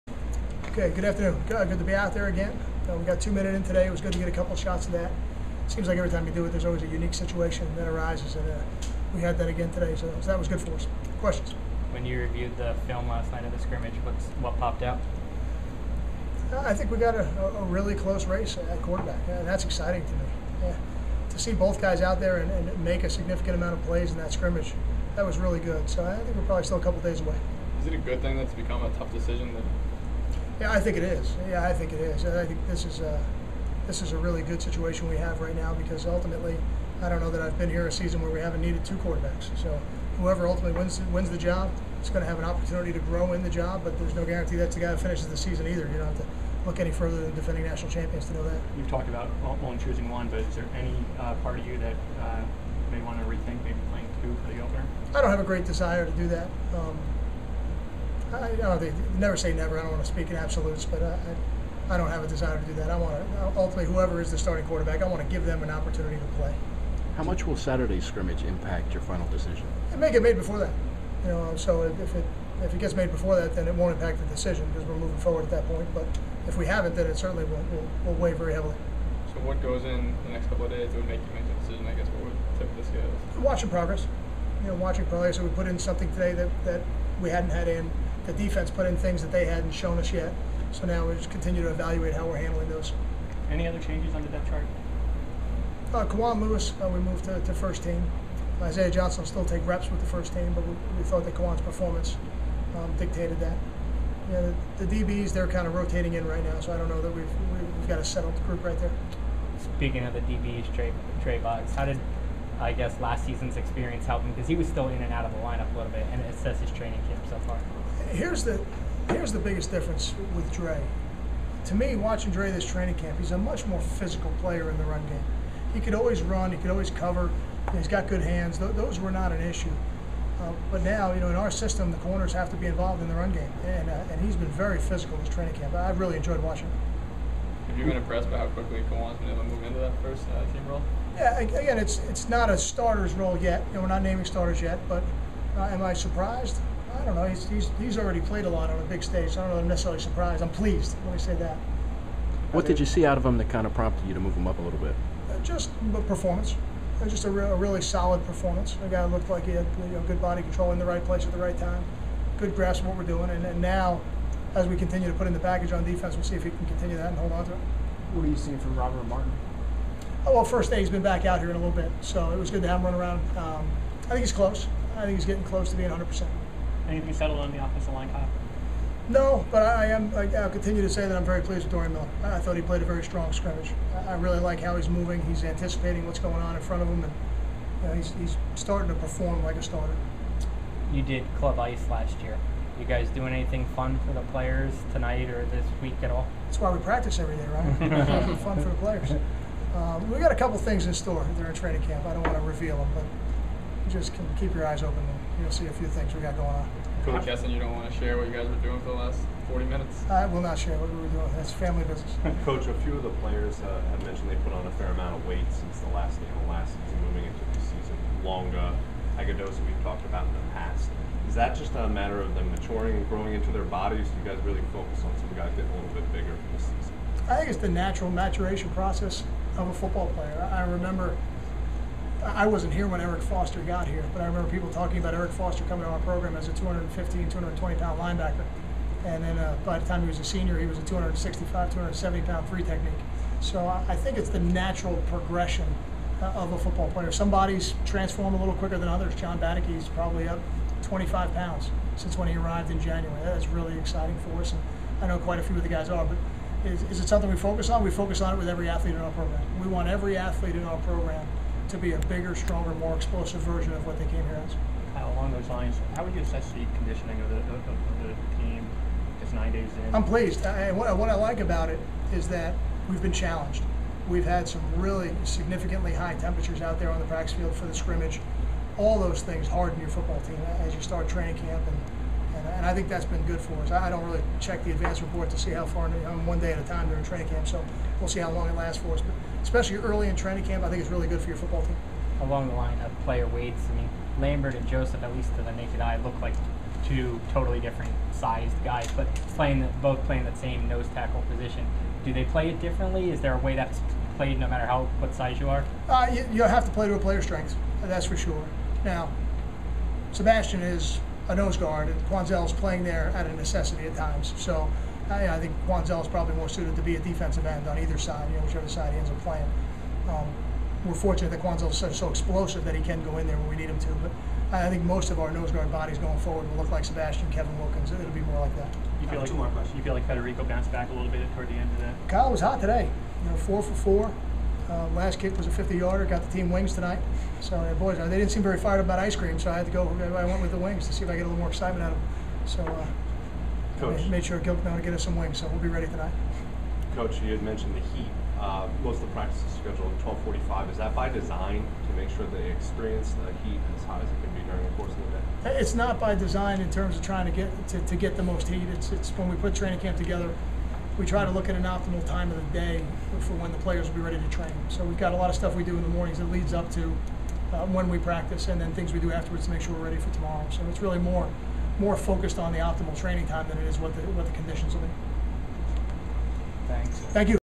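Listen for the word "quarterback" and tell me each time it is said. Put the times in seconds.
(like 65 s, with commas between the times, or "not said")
18 s, 38 s, 64 s.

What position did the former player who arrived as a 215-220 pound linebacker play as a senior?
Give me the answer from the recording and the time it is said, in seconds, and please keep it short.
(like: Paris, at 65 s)
three technique, at 242 s.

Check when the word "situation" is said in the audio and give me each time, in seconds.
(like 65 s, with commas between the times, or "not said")
7 s, 34 s.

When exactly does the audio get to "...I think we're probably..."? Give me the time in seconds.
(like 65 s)
26 s.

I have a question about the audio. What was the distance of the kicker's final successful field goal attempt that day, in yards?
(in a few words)
50.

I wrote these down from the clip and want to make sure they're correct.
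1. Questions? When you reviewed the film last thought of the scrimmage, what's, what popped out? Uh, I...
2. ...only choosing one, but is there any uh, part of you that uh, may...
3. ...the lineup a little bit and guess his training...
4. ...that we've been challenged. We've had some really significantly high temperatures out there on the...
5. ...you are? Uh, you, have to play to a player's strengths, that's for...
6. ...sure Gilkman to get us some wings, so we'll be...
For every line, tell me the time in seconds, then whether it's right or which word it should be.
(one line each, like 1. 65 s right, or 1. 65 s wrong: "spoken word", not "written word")
1. 11 s wrong: "night", not "thought"
2. 49 s right
3. 115 s wrong: "assess", not "guess"
4. 272 s right
5. 305 s right
6. 344 s right.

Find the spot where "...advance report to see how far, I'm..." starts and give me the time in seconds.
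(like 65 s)
284 s.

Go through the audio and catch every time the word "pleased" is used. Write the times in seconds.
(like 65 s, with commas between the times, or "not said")
150 s, 181 s, 270 s.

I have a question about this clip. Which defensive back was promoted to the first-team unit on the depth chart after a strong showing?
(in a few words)
Kawan Lewis.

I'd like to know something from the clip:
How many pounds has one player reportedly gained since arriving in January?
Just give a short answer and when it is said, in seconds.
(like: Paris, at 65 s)
25, at 250 s.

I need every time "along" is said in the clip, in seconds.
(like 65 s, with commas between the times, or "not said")
265 s, 292 s.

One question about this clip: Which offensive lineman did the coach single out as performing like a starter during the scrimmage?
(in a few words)
Dorian Miller.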